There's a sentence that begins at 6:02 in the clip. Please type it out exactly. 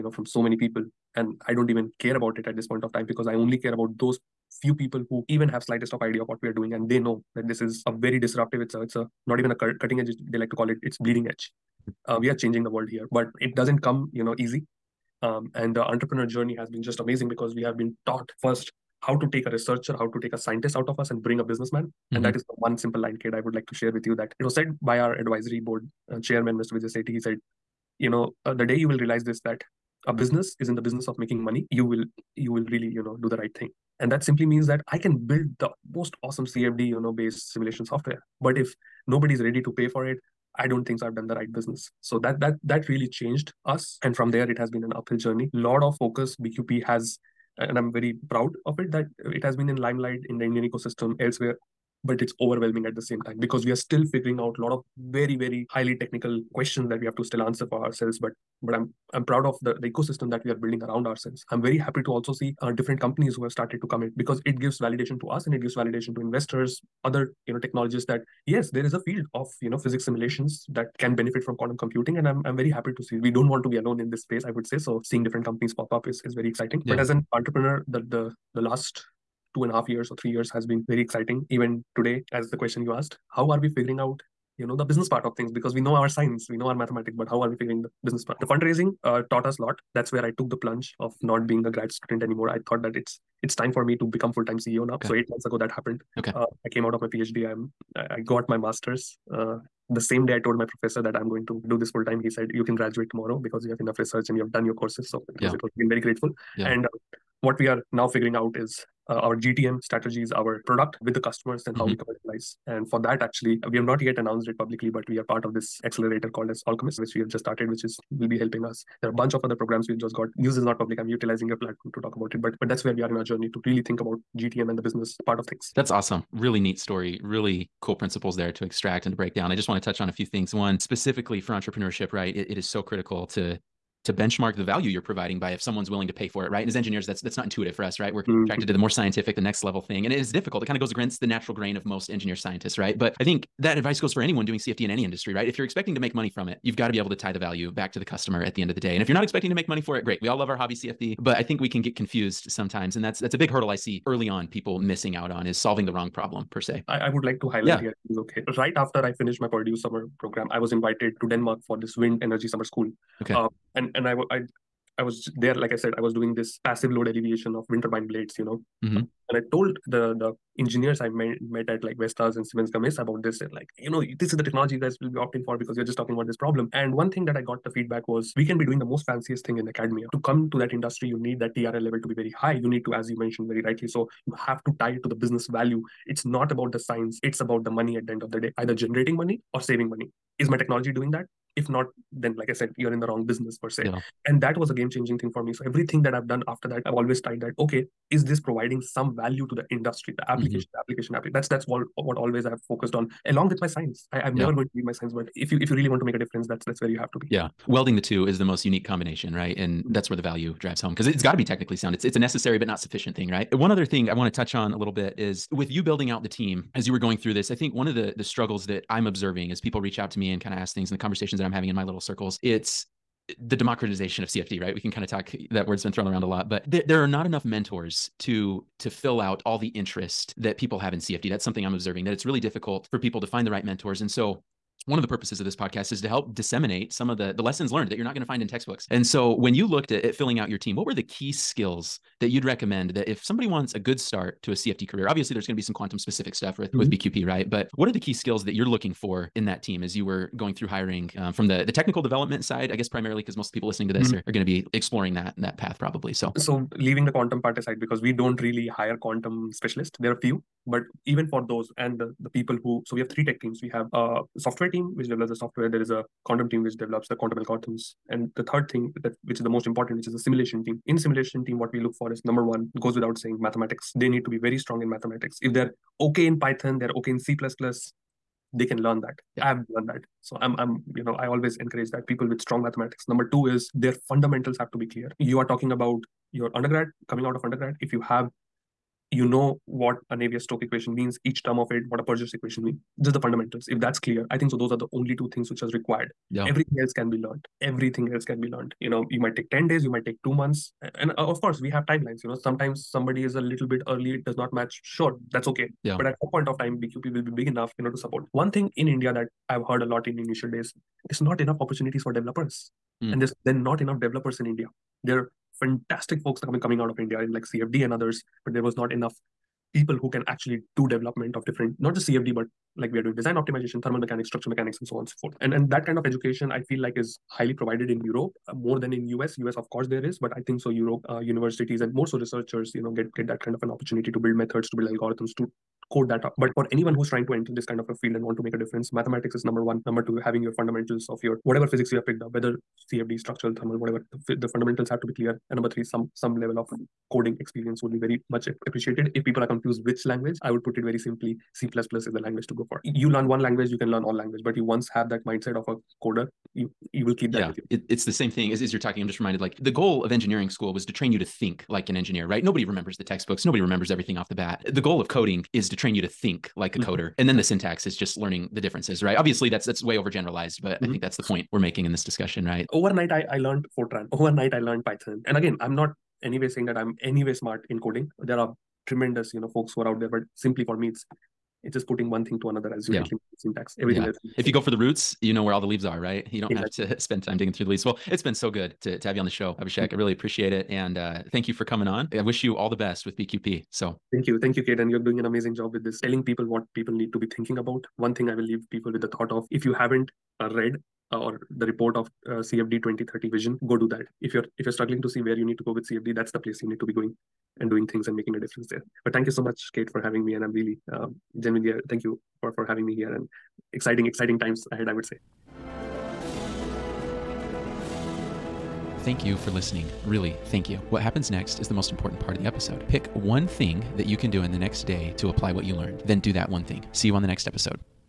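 Nobody remembers the textbooks, nobody remembers everything off the bat.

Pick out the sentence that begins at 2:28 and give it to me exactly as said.
And if you're not expecting to make money for it, great.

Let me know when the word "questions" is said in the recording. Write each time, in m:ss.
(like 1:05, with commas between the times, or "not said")
0:56, 1:22.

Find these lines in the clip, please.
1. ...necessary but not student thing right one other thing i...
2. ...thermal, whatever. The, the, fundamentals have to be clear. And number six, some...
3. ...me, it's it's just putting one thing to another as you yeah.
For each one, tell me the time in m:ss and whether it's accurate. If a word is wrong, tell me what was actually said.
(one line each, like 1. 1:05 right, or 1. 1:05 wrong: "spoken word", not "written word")
1. 3:32 wrong: "sufficient", not "student"
2. 5:43 wrong: "three", not "six"
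3. 6:20 right.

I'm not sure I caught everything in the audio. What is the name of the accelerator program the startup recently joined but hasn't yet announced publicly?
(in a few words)
Alchemist.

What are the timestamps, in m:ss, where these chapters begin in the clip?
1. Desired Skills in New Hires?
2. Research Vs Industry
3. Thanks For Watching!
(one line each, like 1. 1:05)
1. 3:58
2. 2:17
3. 6:55.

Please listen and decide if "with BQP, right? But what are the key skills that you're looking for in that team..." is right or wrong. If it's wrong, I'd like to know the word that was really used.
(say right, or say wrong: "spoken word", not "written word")
right.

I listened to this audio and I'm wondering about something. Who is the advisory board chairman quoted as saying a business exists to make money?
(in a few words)
Vijay Sethi.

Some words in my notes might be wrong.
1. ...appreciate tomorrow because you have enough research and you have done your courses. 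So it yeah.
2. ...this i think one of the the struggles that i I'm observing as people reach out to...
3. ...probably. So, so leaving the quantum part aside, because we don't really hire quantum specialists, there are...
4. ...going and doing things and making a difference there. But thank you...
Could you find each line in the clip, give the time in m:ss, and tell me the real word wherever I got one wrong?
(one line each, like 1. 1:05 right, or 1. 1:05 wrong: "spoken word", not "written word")
1. 1:42 wrong: "graduate", not "appreciate"
2. 3:37 right
3. 4:15 right
4. 6:46 right.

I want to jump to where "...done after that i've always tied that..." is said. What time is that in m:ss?
3:16.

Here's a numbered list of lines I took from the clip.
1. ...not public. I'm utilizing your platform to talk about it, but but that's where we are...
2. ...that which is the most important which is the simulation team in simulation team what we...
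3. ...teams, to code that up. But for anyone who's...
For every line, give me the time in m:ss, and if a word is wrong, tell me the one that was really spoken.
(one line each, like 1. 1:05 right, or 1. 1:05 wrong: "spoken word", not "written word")
1. 2:00 right
2. 4:29 right
3. 5:34 wrong: "algorithms", not "teams".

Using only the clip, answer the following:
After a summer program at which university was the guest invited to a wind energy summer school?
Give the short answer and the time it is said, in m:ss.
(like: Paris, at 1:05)
Purdue, at 2:39.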